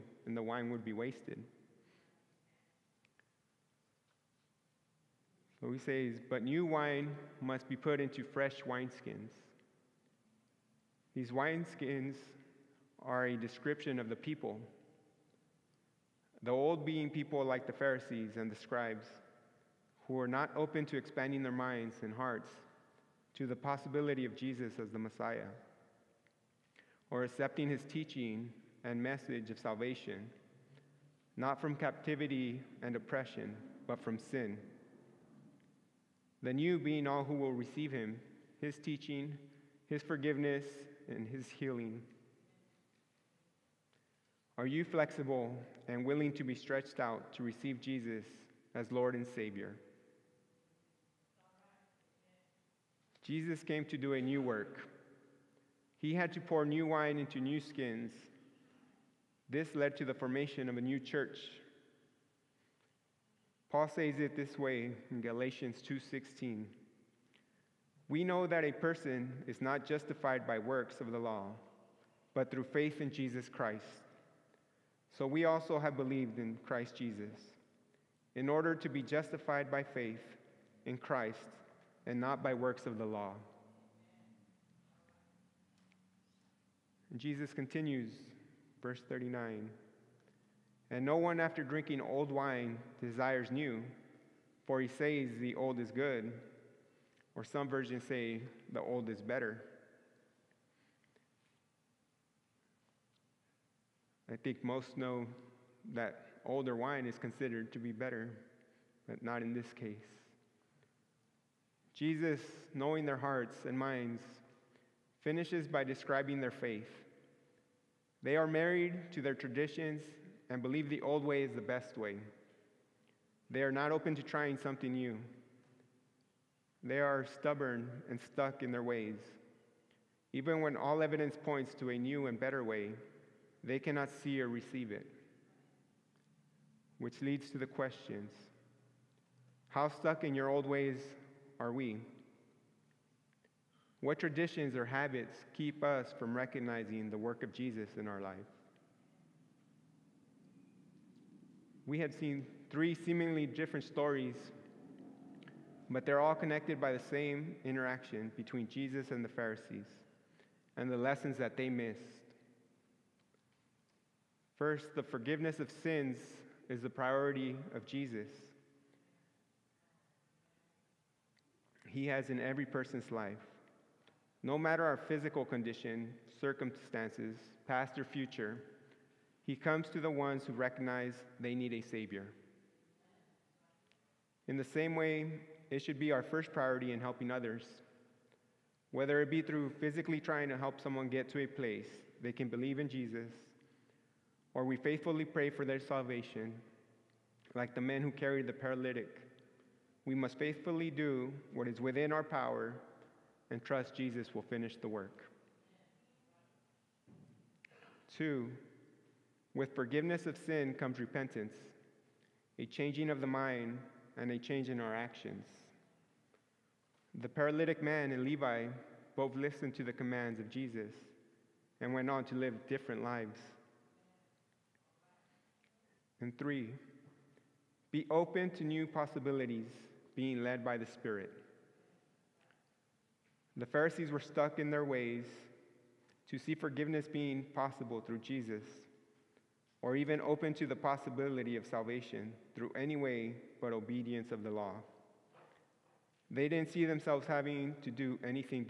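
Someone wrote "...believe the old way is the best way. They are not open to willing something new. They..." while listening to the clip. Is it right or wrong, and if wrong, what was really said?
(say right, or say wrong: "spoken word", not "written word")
wrong: "trying", not "willing".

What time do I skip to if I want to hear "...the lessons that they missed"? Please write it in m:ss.
2:40.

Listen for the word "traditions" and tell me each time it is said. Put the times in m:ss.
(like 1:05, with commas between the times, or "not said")
1:59, 2:24.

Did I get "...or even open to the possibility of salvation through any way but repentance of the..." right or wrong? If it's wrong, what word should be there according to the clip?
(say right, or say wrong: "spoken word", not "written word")
wrong: "obedience", not "repentance".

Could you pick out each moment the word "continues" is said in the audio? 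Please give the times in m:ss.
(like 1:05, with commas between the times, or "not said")
1:27.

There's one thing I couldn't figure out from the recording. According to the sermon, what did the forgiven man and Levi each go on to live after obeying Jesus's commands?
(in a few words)
different lives.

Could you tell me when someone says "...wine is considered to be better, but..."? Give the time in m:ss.
1:46.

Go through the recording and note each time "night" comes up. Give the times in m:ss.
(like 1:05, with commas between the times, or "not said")
not said.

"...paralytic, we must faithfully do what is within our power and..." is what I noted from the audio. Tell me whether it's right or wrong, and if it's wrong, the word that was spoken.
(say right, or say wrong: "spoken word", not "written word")
right.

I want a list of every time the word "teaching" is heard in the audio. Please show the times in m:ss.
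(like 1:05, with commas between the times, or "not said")
0:27, 0:38.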